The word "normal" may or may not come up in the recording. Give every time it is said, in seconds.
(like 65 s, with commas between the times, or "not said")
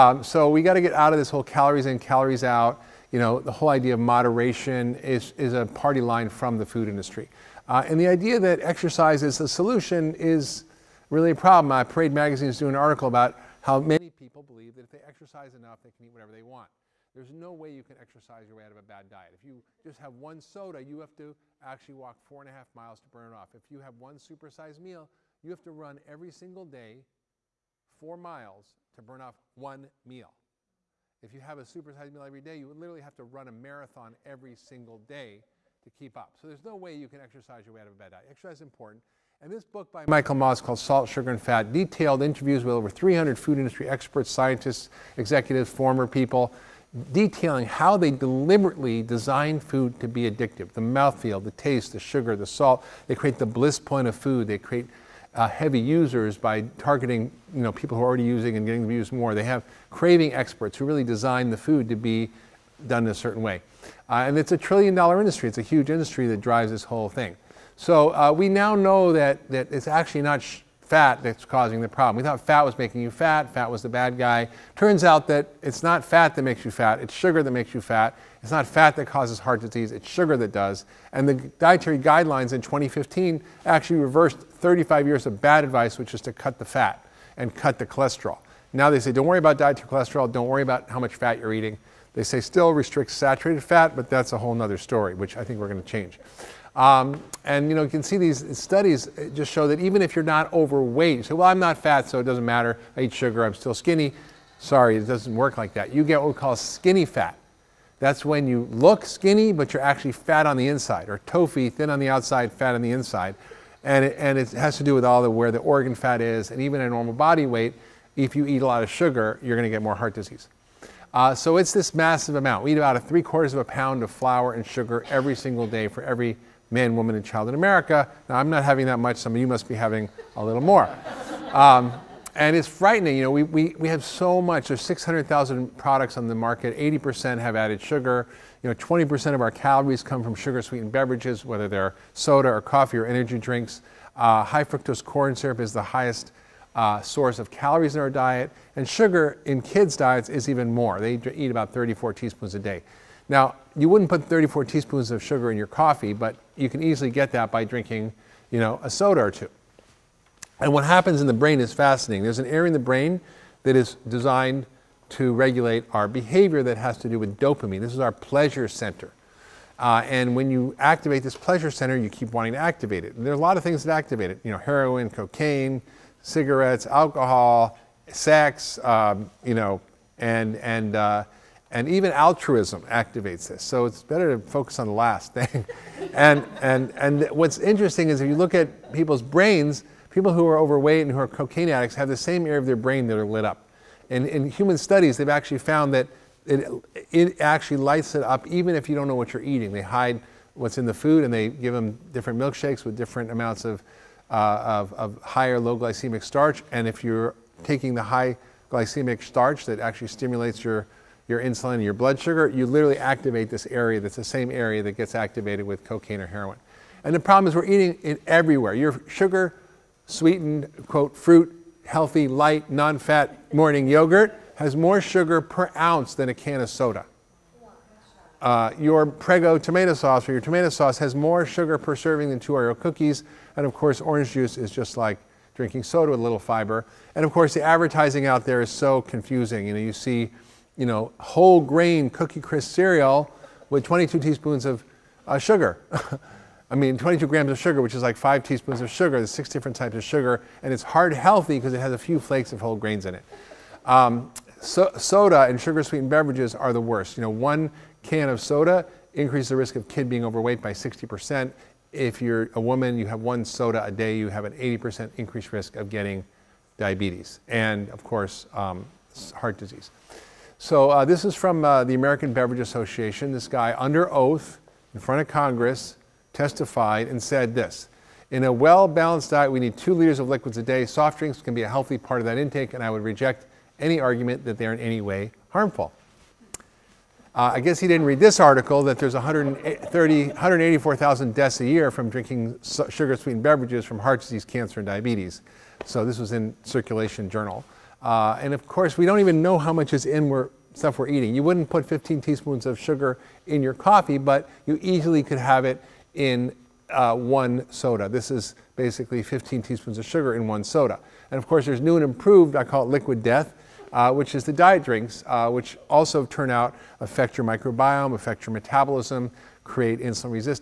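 116 s.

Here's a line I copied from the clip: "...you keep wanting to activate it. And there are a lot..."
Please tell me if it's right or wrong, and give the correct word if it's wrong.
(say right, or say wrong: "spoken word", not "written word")
right.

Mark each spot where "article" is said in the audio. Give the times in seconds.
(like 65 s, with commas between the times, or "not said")
12 s, 288 s.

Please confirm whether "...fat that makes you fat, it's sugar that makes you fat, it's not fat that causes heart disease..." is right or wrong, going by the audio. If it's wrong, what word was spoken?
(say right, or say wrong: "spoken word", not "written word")
right.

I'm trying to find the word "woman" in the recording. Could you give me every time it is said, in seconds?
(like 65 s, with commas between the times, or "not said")
126 s, 262 s.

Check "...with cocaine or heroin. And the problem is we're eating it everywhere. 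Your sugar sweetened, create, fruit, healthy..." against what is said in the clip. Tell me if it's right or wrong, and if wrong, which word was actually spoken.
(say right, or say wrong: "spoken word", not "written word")
wrong: "quote", not "create".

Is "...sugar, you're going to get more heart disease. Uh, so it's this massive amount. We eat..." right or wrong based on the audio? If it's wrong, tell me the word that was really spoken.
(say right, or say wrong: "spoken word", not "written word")
right.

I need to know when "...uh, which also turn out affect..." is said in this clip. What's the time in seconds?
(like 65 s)
315 s.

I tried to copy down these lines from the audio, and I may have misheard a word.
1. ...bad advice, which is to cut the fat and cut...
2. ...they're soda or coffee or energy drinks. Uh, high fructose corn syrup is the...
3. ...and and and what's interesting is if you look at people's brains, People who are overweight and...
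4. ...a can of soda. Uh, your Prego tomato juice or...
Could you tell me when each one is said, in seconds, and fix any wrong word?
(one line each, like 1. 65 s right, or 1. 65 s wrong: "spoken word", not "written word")
1. 85 s right
2. 141 s right
3. 186 s right
4. 226 s wrong: "sauce", not "juice".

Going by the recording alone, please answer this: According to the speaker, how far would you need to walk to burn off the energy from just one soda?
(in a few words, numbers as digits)
4.5 miles.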